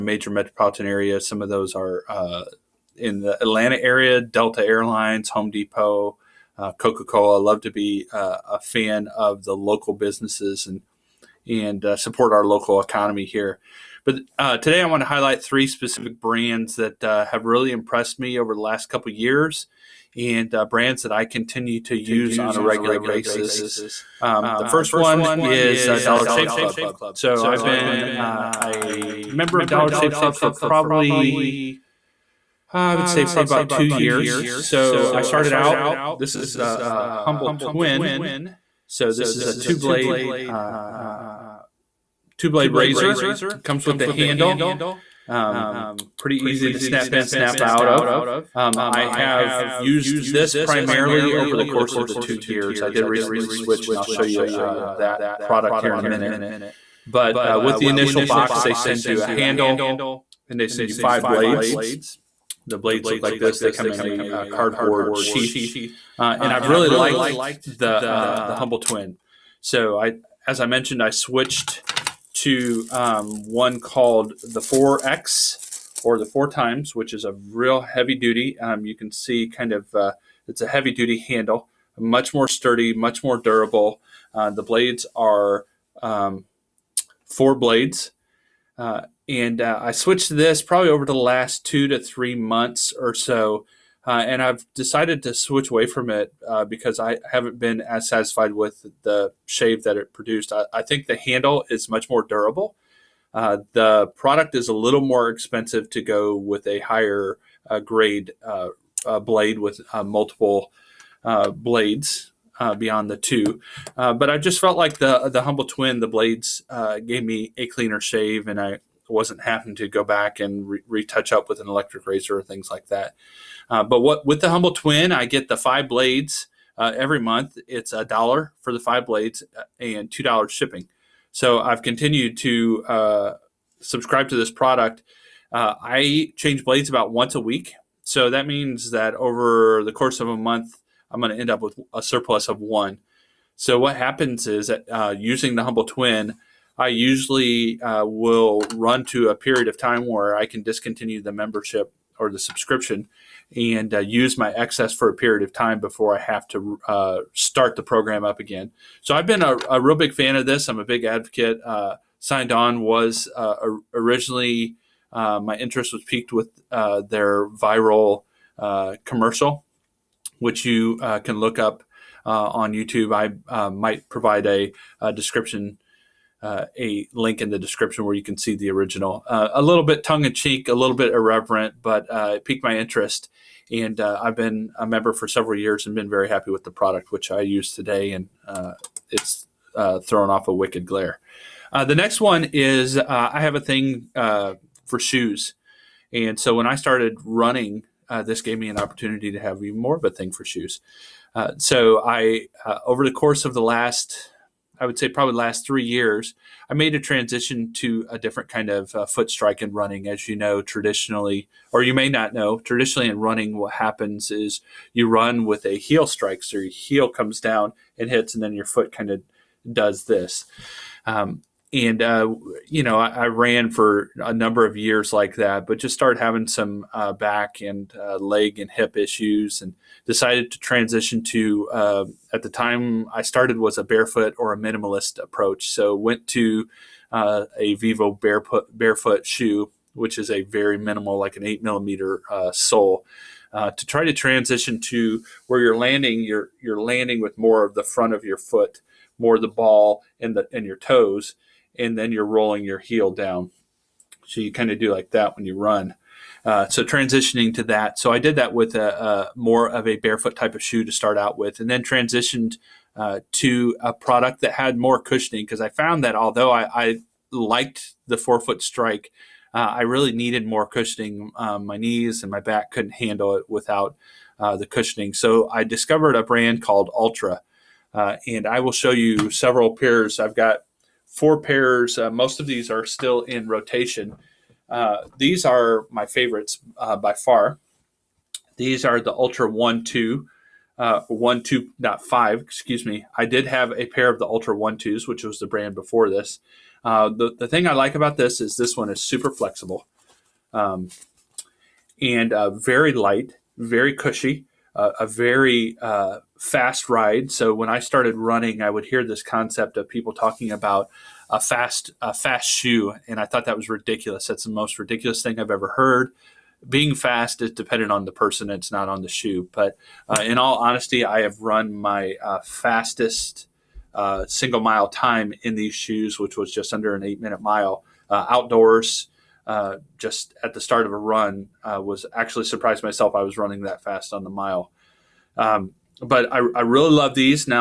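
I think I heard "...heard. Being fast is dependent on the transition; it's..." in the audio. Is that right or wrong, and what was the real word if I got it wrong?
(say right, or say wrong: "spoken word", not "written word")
wrong: "person", not "transition".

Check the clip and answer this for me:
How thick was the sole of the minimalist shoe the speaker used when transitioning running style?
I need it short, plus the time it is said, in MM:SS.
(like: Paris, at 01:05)
8 millimeters, at 04:01.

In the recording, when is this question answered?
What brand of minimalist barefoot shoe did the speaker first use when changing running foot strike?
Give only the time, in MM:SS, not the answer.
03:57.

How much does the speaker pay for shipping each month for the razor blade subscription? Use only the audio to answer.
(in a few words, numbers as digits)
$2.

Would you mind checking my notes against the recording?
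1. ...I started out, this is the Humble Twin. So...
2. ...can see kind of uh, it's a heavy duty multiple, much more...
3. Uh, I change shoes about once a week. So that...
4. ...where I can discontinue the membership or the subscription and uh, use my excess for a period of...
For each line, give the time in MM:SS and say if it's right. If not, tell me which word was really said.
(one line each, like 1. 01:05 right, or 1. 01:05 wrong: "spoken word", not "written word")
1. 00:35 right
2. 01:18 wrong: "handle", not "multiple"
3. 02:15 wrong: "blades", not "shoes"
4. 02:30 right.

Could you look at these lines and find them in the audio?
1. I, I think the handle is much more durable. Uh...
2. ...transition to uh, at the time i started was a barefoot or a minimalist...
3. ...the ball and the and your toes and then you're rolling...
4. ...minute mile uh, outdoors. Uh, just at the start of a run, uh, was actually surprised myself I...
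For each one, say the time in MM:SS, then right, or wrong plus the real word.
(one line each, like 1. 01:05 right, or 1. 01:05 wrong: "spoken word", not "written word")
1. 01:40 right
2. 03:50 right
3. 04:09 right
4. 05:27 right.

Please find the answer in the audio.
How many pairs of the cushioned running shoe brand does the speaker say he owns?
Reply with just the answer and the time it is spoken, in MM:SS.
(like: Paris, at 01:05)
4, at 04:41.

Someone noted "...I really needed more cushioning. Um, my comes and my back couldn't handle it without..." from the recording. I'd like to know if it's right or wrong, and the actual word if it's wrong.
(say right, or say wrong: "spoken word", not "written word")
wrong: "knees", not "comes".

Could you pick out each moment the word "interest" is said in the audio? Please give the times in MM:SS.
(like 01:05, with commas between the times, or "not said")
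02:45, 03:02.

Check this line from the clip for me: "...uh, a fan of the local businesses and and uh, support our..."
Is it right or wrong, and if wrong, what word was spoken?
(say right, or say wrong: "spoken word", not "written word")
right.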